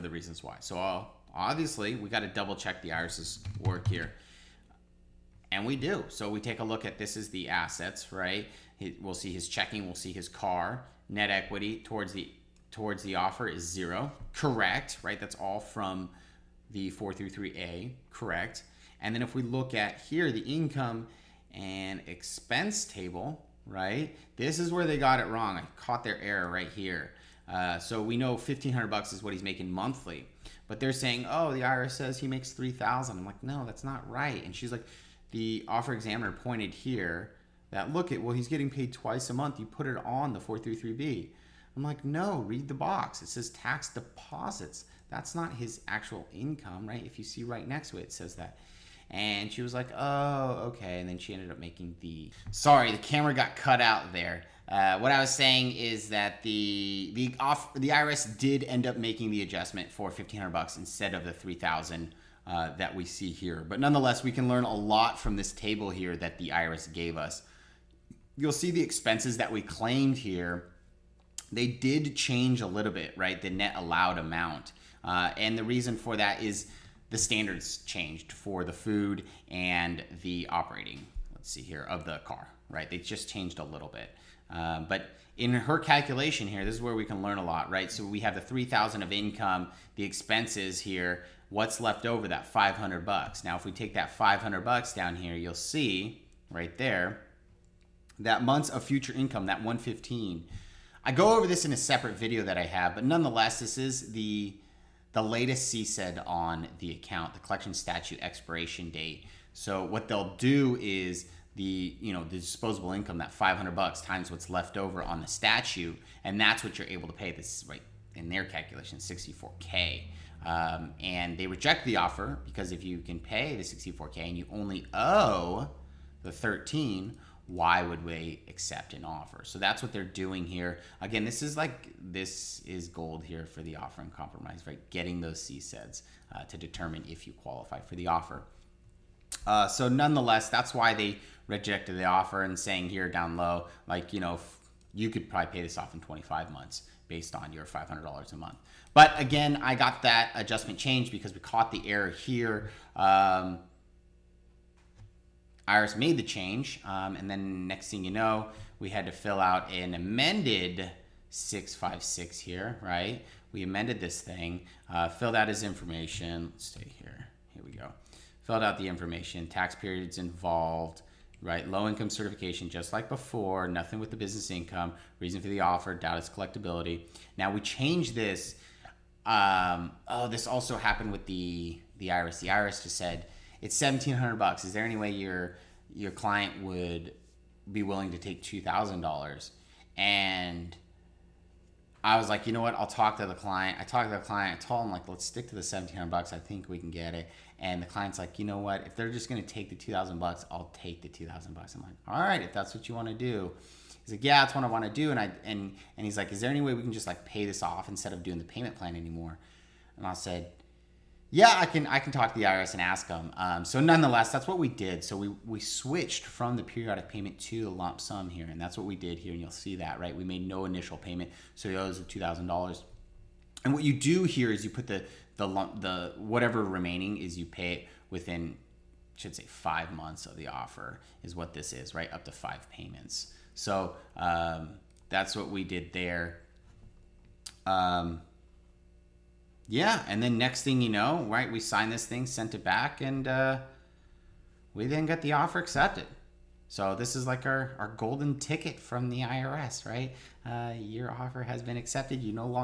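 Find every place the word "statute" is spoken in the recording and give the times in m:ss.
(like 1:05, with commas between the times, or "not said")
1:47, 1:55.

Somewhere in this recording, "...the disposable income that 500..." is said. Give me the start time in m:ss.
1:52.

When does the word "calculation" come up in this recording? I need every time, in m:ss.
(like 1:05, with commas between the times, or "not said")
1:25, 1:58.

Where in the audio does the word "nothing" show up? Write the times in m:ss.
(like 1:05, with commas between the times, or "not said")
2:53.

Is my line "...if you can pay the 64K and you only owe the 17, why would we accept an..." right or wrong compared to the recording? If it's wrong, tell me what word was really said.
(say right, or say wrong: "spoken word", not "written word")
wrong: "13", not "17".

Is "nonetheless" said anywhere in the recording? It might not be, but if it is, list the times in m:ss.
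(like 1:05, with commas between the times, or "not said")
1:03, 1:43, 2:19, 3:33.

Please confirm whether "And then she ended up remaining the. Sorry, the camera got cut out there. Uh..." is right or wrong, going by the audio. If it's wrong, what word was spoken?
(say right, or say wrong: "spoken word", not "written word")
wrong: "making", not "remaining".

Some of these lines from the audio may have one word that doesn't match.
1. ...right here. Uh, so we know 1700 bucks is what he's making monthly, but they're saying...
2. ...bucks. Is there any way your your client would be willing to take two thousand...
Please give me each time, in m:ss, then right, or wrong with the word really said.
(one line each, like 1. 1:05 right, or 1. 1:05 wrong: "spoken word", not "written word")
1. 0:26 wrong: "1500", not "1700"
2. 3:04 right.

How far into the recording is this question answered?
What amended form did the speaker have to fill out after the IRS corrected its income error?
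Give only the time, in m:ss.
2:41.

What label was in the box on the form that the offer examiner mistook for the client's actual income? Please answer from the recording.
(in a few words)
Tax deposits.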